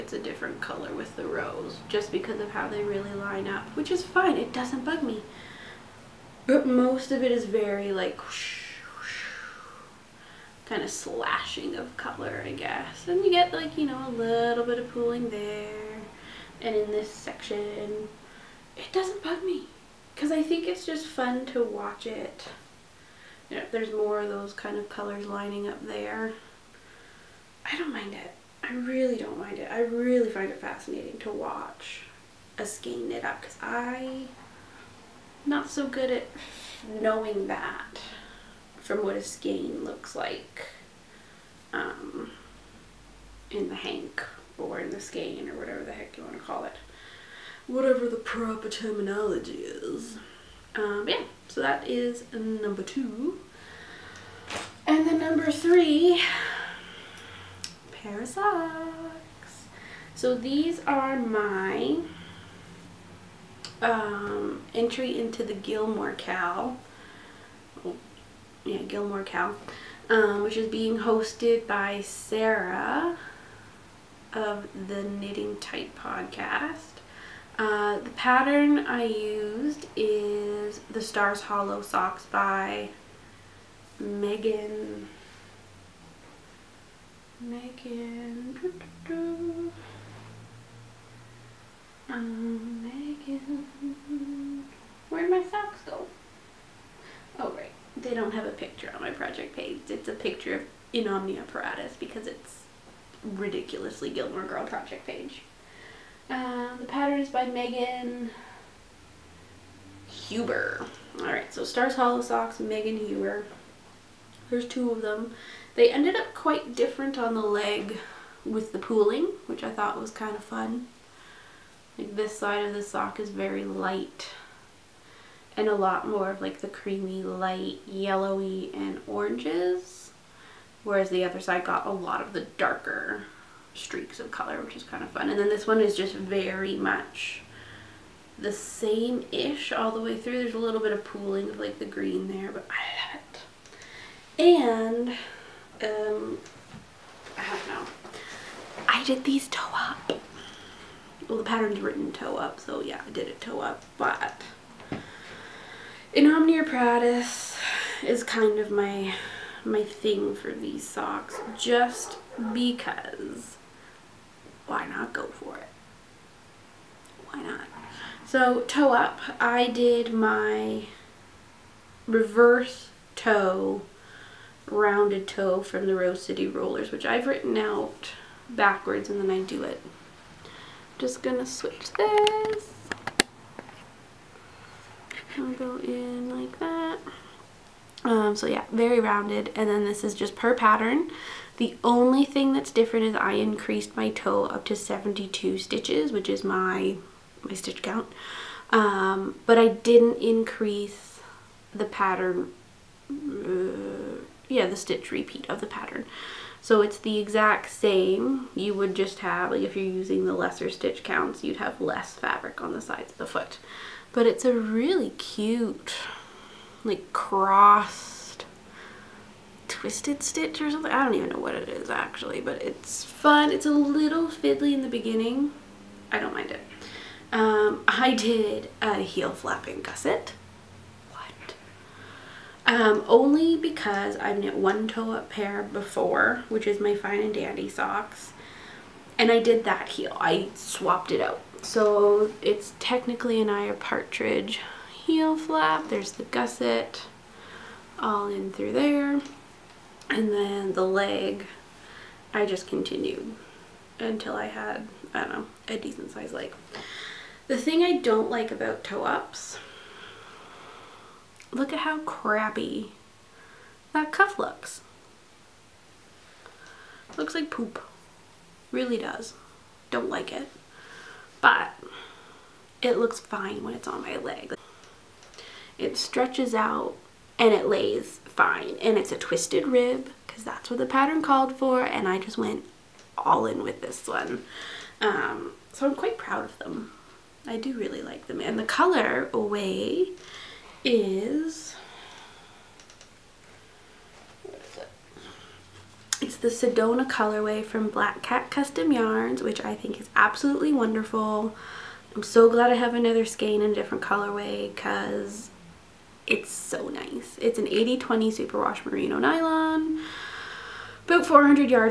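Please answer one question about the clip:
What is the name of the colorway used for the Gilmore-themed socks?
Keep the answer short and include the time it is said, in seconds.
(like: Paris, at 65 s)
Sedona, at 296 s.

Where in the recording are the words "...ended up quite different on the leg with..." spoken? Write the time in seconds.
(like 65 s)
115 s.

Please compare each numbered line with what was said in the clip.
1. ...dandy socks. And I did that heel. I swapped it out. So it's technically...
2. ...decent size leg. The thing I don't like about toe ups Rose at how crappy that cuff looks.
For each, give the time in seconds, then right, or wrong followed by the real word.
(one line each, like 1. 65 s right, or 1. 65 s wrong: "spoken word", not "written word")
1. 237 s right
2. 255 s wrong: "Look", not "Rose".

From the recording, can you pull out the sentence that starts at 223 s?
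It's a little fiddly in the beginning.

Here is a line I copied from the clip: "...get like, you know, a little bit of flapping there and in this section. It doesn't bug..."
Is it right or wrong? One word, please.
wrong.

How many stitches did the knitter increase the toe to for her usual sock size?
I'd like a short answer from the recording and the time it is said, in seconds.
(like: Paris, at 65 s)
72, at 194 s.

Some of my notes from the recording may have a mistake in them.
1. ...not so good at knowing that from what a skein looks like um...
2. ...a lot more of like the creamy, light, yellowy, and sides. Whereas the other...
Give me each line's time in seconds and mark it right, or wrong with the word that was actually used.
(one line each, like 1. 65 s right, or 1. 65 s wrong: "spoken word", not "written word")
1. 35 s right
2. 125 s wrong: "oranges", not "sides".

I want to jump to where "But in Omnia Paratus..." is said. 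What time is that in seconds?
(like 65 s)
153 s.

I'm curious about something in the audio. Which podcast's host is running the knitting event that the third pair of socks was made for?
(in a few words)
Knitting Tight.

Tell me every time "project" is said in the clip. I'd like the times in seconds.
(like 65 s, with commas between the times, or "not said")
99 s, 104 s.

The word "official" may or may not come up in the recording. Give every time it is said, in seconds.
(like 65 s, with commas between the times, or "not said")
not said.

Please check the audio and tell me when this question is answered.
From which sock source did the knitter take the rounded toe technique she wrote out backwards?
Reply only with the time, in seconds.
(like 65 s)
175 s.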